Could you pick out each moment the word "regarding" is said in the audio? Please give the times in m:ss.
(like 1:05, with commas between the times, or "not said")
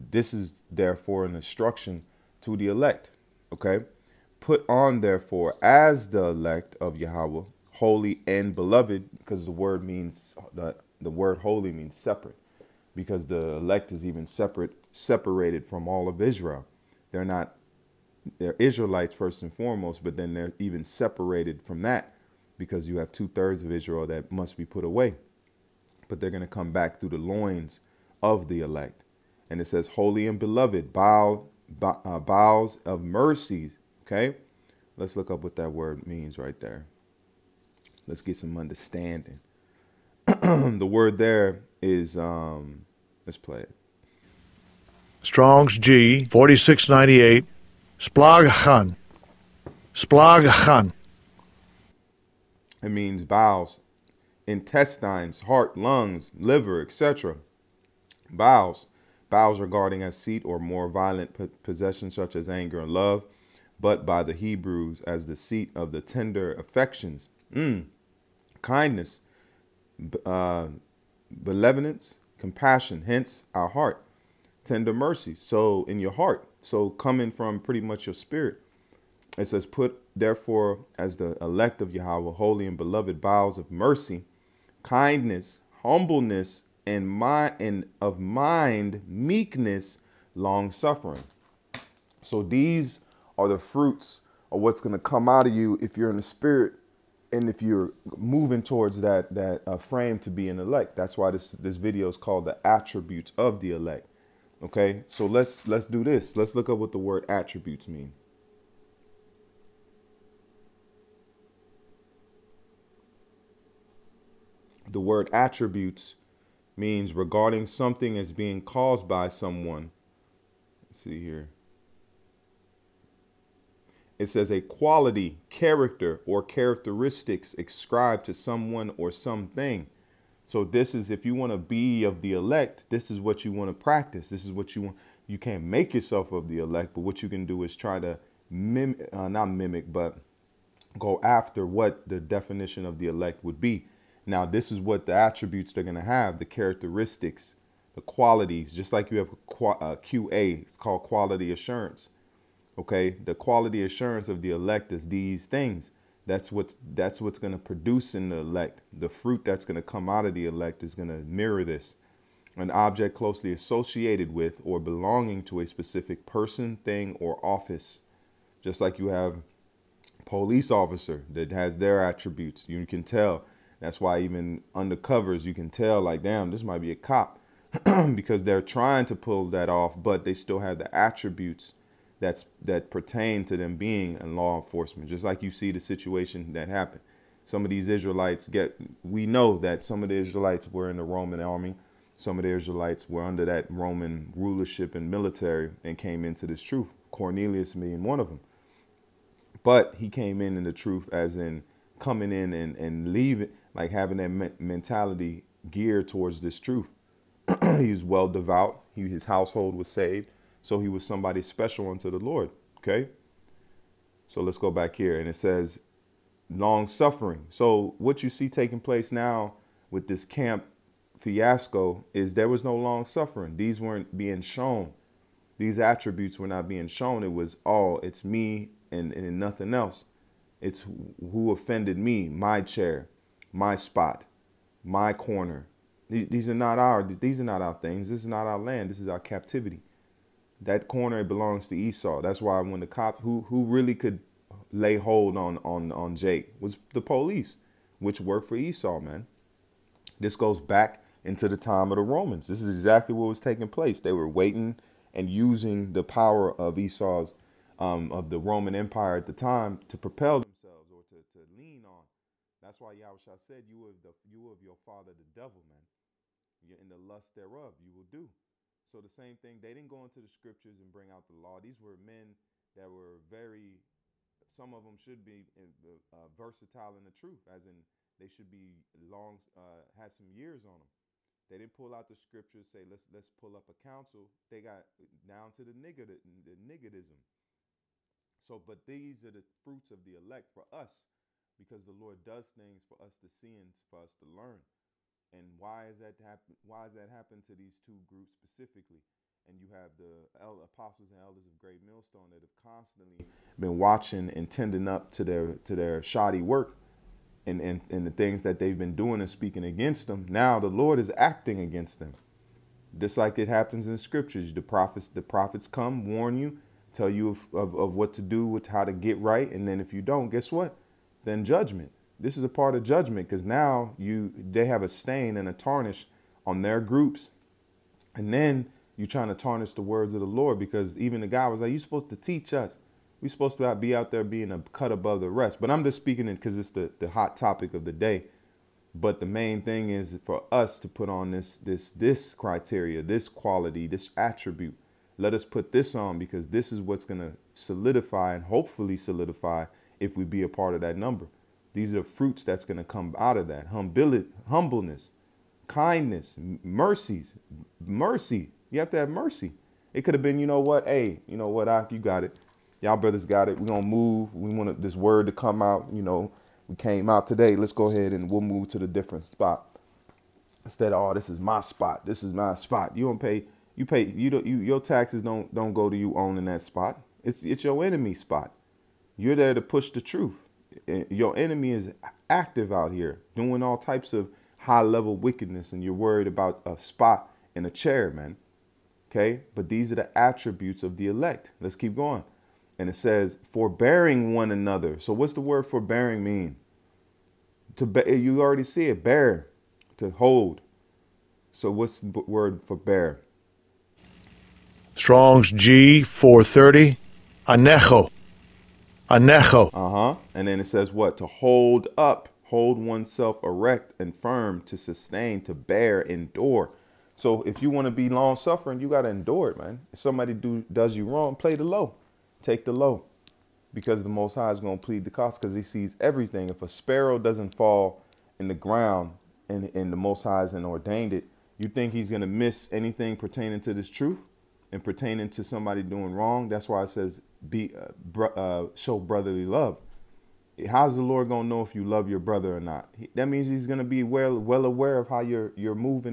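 0:59, 1:57.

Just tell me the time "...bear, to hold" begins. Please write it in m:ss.
6:39.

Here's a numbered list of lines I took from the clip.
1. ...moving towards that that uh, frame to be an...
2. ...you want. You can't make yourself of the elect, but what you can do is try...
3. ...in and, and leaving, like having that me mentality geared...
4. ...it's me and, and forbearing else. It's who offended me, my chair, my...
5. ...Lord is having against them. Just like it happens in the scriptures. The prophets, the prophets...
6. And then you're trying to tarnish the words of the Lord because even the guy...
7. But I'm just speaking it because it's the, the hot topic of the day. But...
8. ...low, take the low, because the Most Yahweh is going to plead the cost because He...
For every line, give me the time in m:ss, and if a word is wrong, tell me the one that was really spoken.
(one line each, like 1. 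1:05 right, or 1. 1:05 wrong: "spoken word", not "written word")
1. 1:38 right
2. 2:14 right
3. 3:22 right
4. 3:48 wrong: "nothing", not "forbearing"
5. 5:10 wrong: "acting", not "having"
6. 5:28 right
7. 5:35 right
8. 7:01 wrong: "High", not "Yahweh".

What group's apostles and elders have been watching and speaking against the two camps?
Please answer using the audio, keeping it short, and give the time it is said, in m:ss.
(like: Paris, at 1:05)
Great Millstone, at 5:01.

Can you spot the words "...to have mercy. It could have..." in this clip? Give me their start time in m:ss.
5:58.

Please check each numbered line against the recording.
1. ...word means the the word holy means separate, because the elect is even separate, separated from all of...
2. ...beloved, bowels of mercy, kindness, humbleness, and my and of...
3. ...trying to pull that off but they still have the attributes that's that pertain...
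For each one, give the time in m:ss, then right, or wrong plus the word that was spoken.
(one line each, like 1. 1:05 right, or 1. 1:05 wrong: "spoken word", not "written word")
1. 0:09 right
2. 1:22 right
3. 2:58 right.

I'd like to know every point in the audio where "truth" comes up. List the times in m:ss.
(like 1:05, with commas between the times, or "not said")
3:16, 3:20, 3:26, 4:37, 6:19, 7:13.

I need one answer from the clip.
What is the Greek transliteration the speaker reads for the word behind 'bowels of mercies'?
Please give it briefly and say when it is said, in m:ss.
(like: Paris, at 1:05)
Splagchnon, at 0:48.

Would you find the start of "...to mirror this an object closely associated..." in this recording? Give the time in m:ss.
2:41.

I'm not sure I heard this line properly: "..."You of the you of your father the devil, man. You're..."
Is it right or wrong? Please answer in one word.
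right.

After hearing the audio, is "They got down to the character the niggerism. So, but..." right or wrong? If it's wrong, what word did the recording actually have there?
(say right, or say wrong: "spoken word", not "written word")
wrong: "nigger", not "character".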